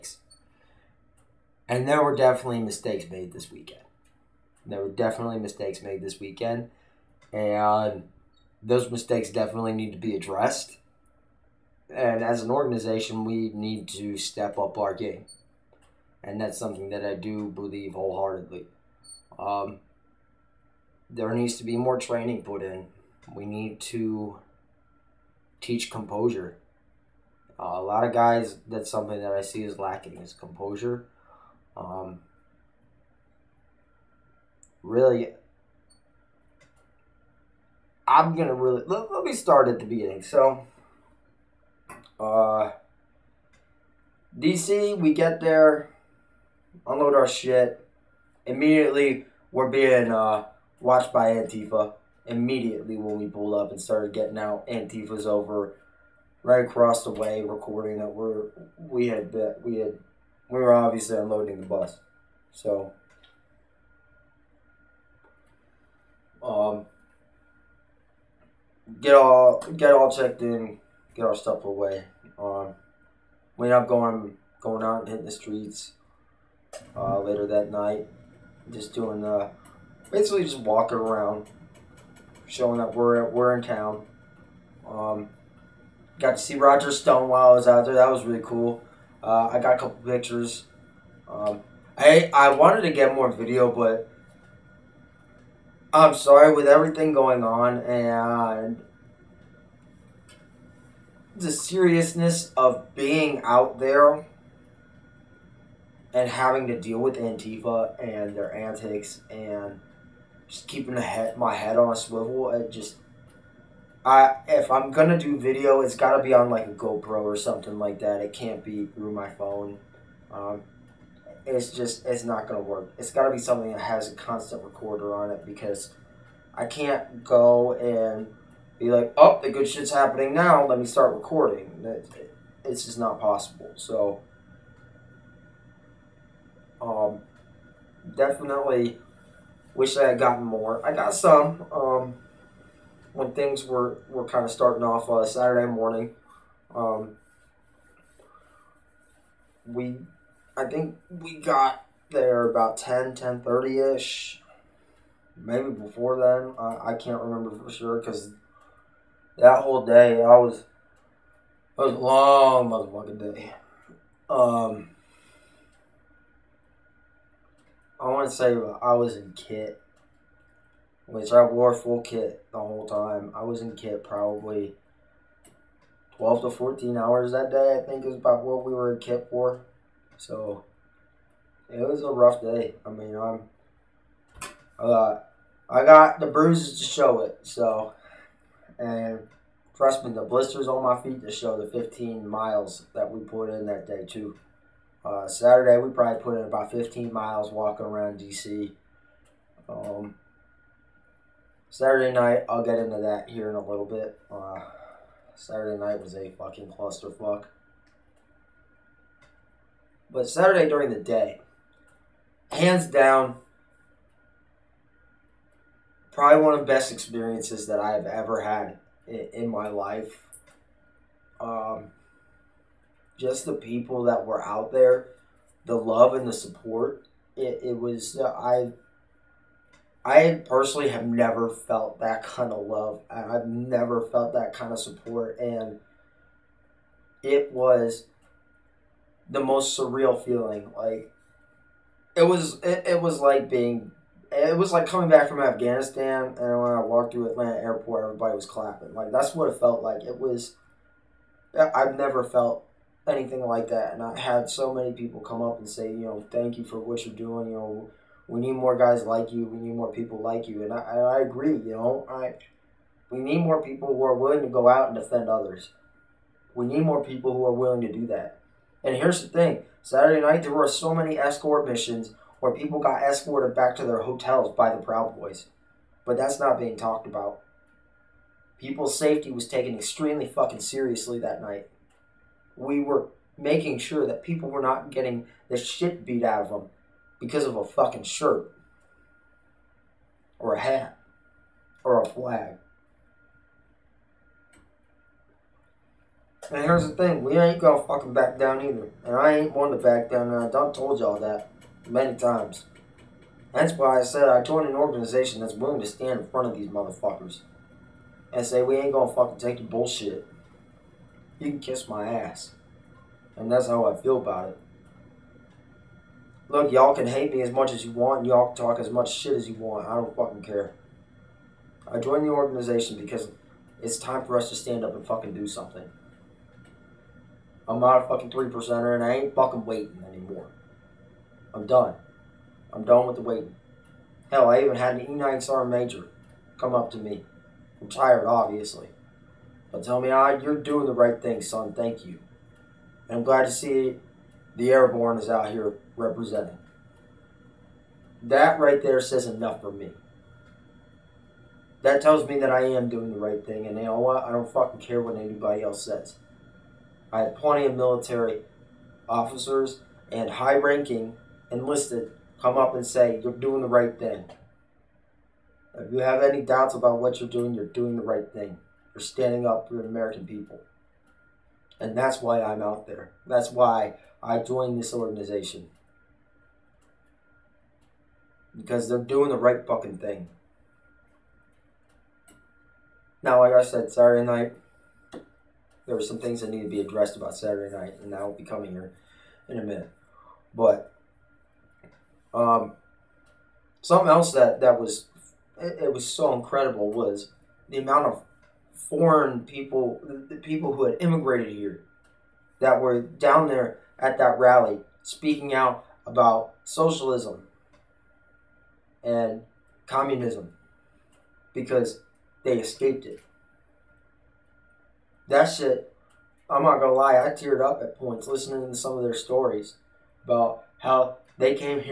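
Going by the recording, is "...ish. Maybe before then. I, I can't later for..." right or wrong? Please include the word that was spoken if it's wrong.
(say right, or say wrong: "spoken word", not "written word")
wrong: "remember", not "later".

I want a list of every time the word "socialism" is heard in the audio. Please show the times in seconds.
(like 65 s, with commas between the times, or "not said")
406 s.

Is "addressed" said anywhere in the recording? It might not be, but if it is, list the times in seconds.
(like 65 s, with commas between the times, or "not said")
10 s, 386 s.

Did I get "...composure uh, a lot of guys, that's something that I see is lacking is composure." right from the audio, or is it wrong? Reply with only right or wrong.
right.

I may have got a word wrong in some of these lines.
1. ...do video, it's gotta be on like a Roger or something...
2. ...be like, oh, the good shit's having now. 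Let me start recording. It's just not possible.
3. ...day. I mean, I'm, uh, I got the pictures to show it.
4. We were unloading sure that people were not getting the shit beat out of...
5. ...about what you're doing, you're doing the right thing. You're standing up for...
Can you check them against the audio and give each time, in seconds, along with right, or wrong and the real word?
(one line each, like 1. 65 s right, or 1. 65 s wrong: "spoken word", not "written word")
1. 115 s wrong: "GoPro", not "Roger"
2. 128 s wrong: "happening", not "having"
3. 182 s wrong: "bruises", not "pictures"
4. 282 s wrong: "making", not "unloading"
5. 366 s right.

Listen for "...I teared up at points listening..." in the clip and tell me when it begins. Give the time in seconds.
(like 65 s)
417 s.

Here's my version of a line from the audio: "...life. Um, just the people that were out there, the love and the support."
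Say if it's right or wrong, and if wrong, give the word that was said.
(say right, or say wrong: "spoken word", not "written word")
right.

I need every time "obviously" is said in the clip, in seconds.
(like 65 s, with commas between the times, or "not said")
60 s, 338 s.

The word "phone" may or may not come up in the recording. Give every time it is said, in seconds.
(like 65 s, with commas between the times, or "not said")
119 s.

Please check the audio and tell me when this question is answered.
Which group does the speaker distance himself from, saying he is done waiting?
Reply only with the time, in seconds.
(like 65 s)
328 s.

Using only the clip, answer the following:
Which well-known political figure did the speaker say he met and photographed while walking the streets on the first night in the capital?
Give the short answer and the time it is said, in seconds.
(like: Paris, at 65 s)
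Roger Stone, at 86 s.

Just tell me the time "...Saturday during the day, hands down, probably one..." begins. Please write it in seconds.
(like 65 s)
210 s.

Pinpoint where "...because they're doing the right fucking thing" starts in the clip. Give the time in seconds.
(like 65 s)
378 s.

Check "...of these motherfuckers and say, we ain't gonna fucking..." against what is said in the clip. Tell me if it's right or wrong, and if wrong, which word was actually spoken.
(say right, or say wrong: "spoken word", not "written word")
right.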